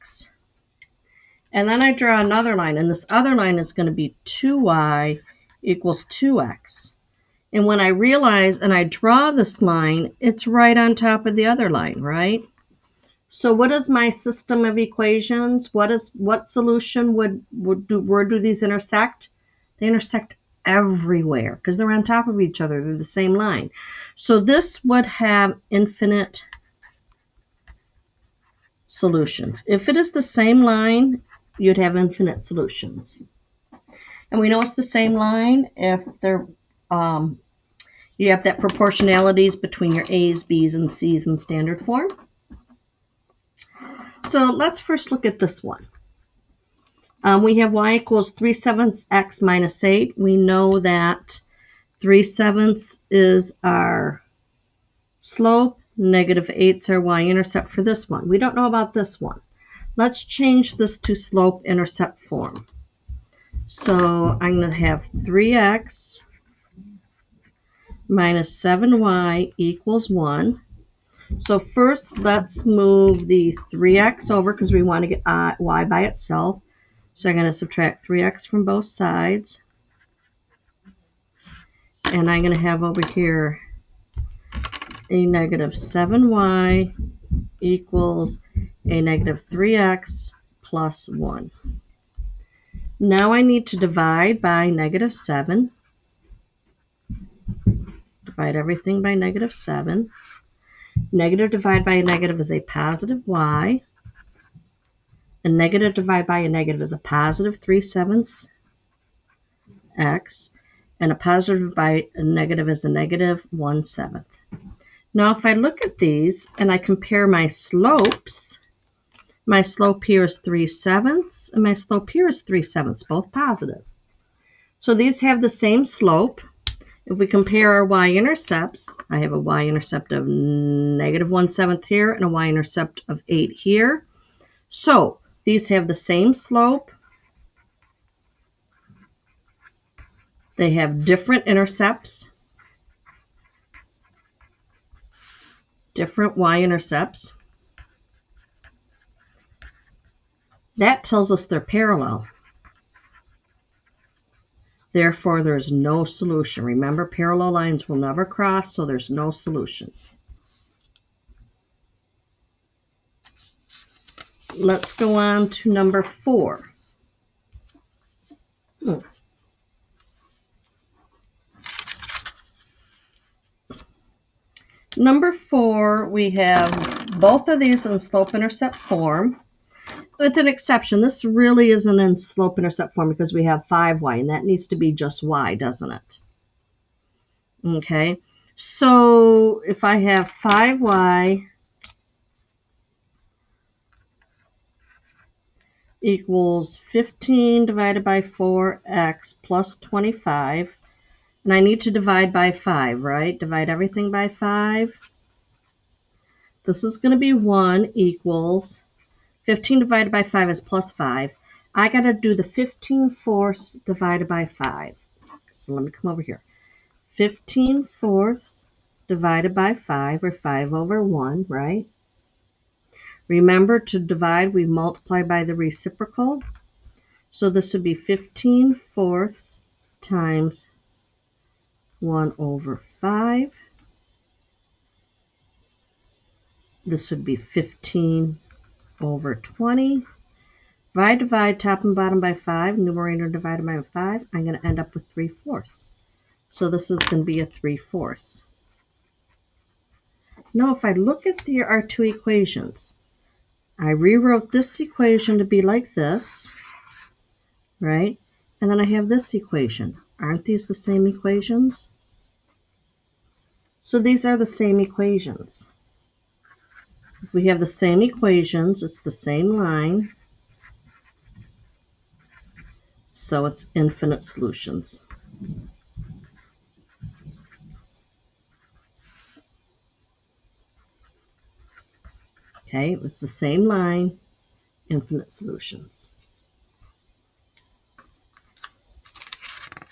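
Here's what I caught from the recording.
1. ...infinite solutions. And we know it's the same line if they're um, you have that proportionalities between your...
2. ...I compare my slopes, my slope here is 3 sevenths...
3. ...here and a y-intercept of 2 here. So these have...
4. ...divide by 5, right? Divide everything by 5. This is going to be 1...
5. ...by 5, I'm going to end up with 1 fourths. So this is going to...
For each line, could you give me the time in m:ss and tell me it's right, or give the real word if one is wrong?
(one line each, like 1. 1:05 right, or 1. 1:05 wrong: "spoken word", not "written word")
1. 0:31 right
2. 1:56 right
3. 2:11 wrong: "8", not "2"
4. 3:21 right
5. 4:03 wrong: "3", not "1".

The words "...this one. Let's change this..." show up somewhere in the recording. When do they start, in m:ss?
0:58.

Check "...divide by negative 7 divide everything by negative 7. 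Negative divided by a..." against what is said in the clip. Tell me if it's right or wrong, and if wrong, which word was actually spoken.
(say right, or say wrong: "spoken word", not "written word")
right.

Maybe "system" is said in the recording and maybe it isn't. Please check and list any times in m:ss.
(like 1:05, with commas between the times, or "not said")
0:14.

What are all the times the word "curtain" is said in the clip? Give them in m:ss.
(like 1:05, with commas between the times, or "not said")
not said.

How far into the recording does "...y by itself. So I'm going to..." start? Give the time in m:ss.
1:15.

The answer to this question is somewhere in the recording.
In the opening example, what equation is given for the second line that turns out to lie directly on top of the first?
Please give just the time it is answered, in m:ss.
0:04.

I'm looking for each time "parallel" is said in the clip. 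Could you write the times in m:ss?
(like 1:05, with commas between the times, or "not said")
2:31, 2:37.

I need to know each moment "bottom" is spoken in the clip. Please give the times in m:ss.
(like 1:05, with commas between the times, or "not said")
4:01.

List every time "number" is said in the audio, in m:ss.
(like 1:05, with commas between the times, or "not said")
2:45, 2:54.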